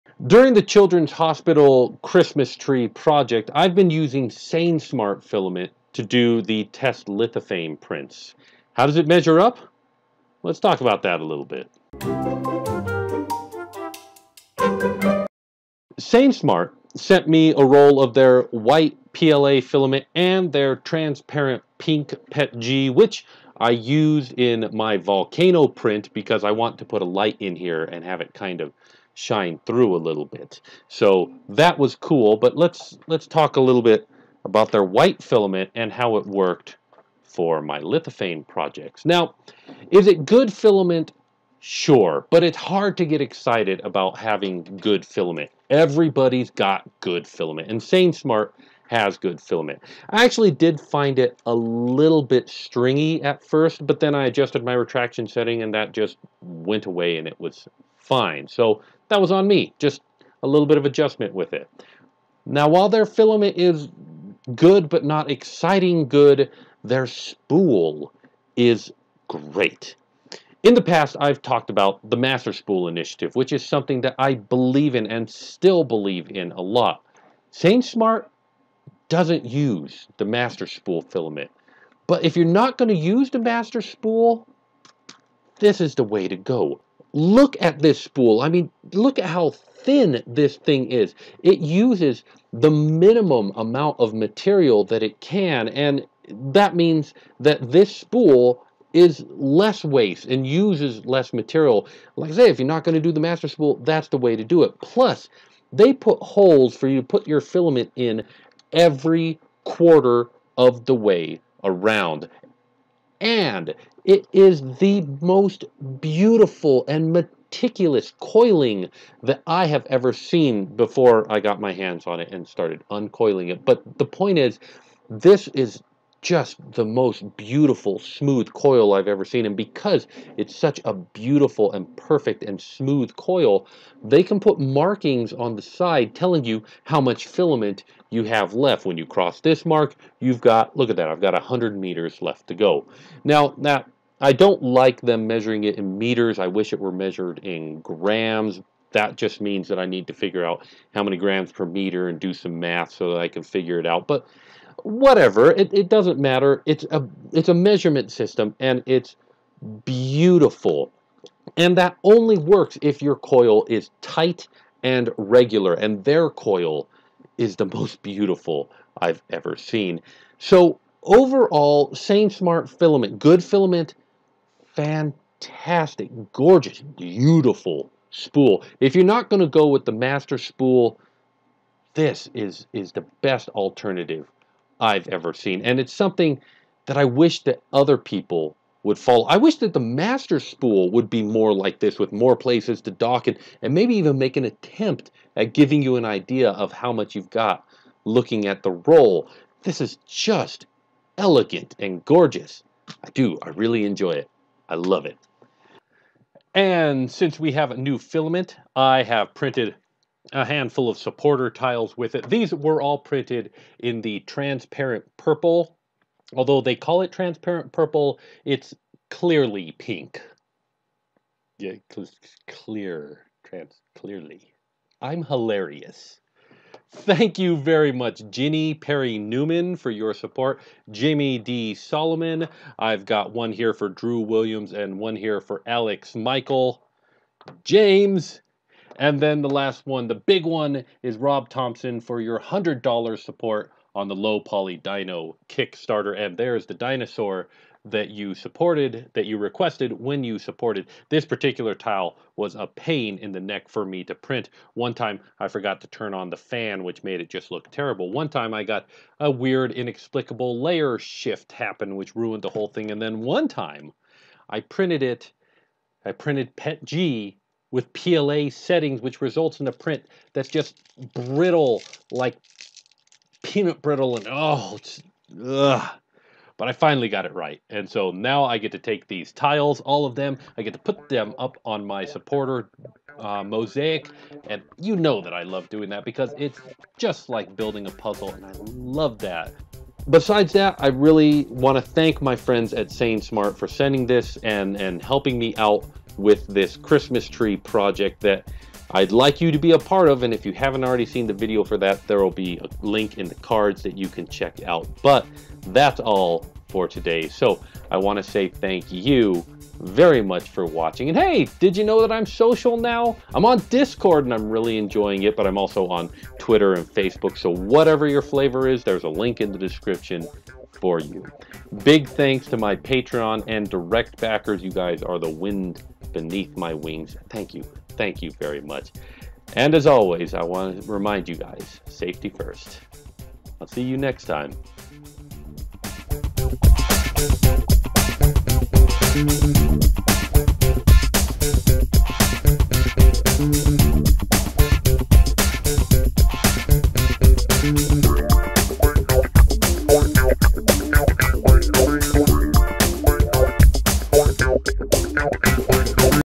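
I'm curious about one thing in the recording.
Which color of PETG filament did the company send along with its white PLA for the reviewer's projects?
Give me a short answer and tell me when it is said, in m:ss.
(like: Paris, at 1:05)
Transparent pink, at 0:20.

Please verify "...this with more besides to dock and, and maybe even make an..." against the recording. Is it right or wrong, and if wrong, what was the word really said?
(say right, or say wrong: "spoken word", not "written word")
wrong: "places", not "besides".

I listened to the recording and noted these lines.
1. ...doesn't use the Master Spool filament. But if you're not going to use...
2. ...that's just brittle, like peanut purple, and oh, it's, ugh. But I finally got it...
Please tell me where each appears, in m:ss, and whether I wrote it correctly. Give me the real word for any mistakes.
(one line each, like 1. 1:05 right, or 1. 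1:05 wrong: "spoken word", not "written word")
1. 1:19 right
2. 4:30 wrong: "brittle", not "purple".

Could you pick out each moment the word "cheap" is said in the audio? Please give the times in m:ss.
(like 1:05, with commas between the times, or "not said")
not said.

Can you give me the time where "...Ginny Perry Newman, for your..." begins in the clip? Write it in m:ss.
3:48.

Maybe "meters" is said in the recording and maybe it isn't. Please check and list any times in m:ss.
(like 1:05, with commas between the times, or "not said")
2:21, 2:25, 2:31.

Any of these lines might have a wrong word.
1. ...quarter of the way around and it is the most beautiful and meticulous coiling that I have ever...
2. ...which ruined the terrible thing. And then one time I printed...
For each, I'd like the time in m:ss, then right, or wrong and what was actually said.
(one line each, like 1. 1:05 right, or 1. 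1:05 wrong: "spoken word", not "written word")
1. 1:49 right
2. 4:21 wrong: "whole", not "terrible".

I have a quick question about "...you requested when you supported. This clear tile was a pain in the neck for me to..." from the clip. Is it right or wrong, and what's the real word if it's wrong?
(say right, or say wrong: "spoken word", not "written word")
wrong: "particular", not "clear".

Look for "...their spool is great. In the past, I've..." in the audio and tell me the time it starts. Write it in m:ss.
1:06.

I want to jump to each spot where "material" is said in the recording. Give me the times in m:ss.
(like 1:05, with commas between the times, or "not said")
1:34, 1:41.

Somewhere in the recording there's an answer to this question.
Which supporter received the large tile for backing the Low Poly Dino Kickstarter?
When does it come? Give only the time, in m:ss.
4:01.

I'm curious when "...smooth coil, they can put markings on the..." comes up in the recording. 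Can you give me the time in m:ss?
2:12.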